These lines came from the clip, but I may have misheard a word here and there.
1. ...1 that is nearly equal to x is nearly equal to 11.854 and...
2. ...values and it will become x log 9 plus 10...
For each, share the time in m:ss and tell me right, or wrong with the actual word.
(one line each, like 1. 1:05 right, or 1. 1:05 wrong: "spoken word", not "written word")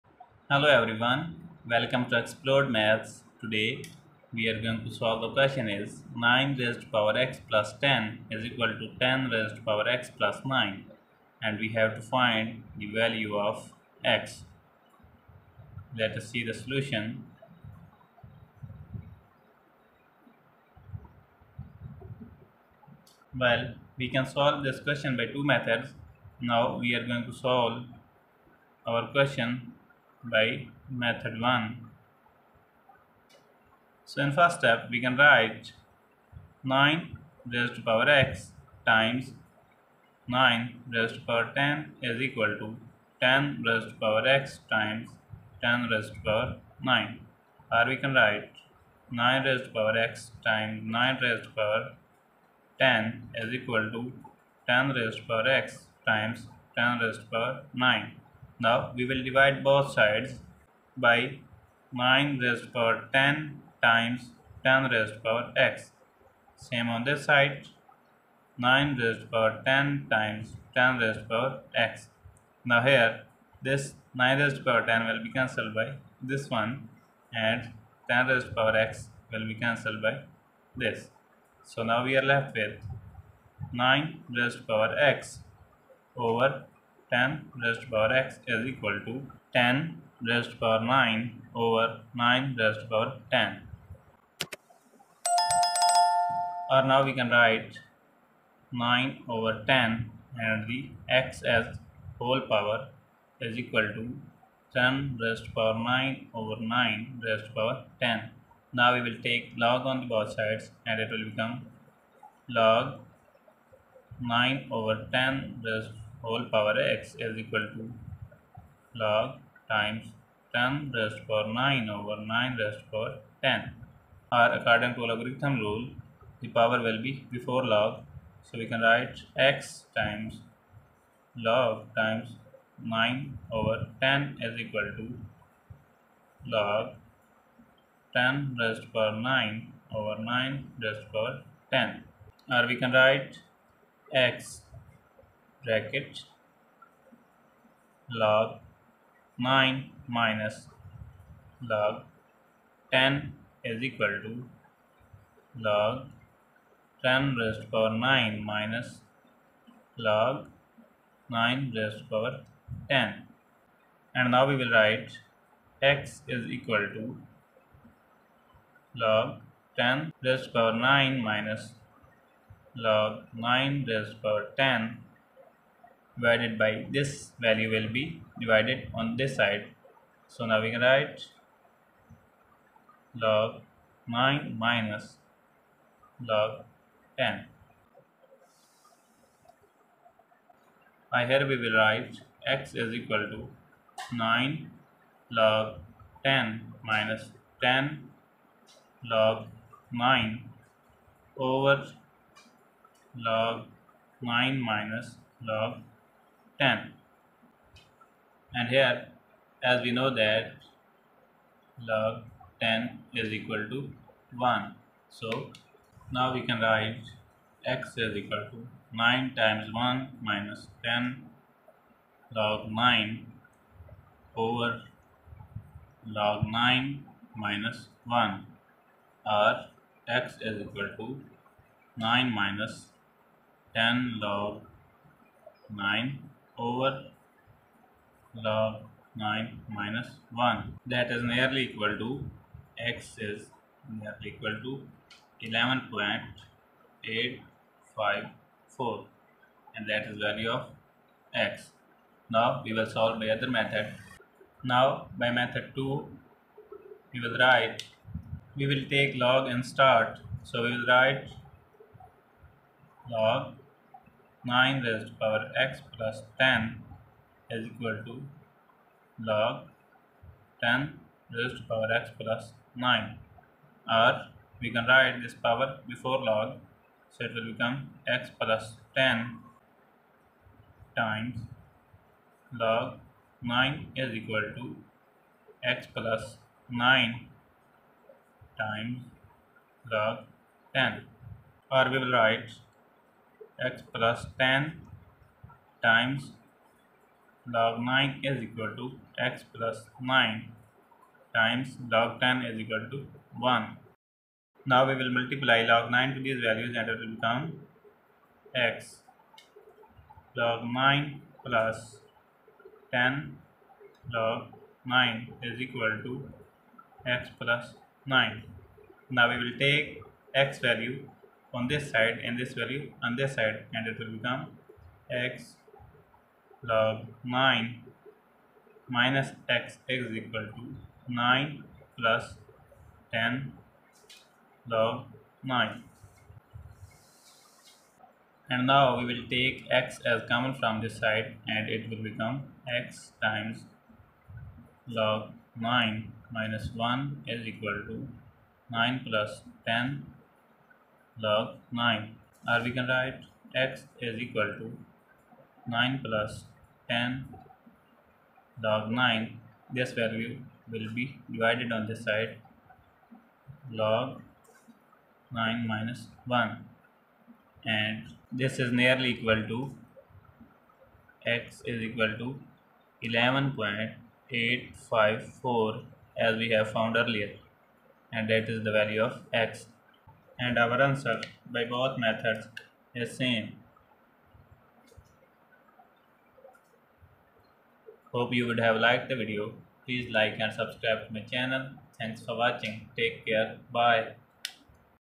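1. 4:00 right
2. 5:06 right.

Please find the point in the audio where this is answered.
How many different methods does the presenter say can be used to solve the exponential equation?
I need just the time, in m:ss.
0:25.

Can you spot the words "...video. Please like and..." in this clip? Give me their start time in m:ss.
6:29.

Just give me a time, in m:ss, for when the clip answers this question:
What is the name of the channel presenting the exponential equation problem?
0:02.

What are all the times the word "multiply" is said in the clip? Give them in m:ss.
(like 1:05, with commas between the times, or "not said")
5:05.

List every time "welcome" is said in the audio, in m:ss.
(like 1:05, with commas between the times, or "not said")
0:01.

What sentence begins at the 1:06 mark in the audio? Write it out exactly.
Same on this side 9 raised power 10 times 10 raised power x.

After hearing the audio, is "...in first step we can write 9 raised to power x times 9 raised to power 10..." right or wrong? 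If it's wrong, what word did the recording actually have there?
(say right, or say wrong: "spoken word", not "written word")
right.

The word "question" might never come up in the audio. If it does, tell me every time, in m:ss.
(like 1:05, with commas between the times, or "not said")
0:05, 0:24, 0:29.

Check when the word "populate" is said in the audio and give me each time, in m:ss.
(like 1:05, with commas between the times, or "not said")
not said.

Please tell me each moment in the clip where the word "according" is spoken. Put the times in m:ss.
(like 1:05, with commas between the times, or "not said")
2:04.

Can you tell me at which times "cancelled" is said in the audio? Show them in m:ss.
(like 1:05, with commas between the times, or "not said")
1:15, 1:19.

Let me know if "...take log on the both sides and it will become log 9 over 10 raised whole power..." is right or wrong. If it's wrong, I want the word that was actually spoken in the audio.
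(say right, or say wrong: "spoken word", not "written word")
right.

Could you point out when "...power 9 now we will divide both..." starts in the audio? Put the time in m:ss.
0:57.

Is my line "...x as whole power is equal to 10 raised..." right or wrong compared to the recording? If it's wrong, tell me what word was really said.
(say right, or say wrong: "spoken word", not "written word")
right.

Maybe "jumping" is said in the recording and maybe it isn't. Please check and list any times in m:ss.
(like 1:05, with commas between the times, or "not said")
not said.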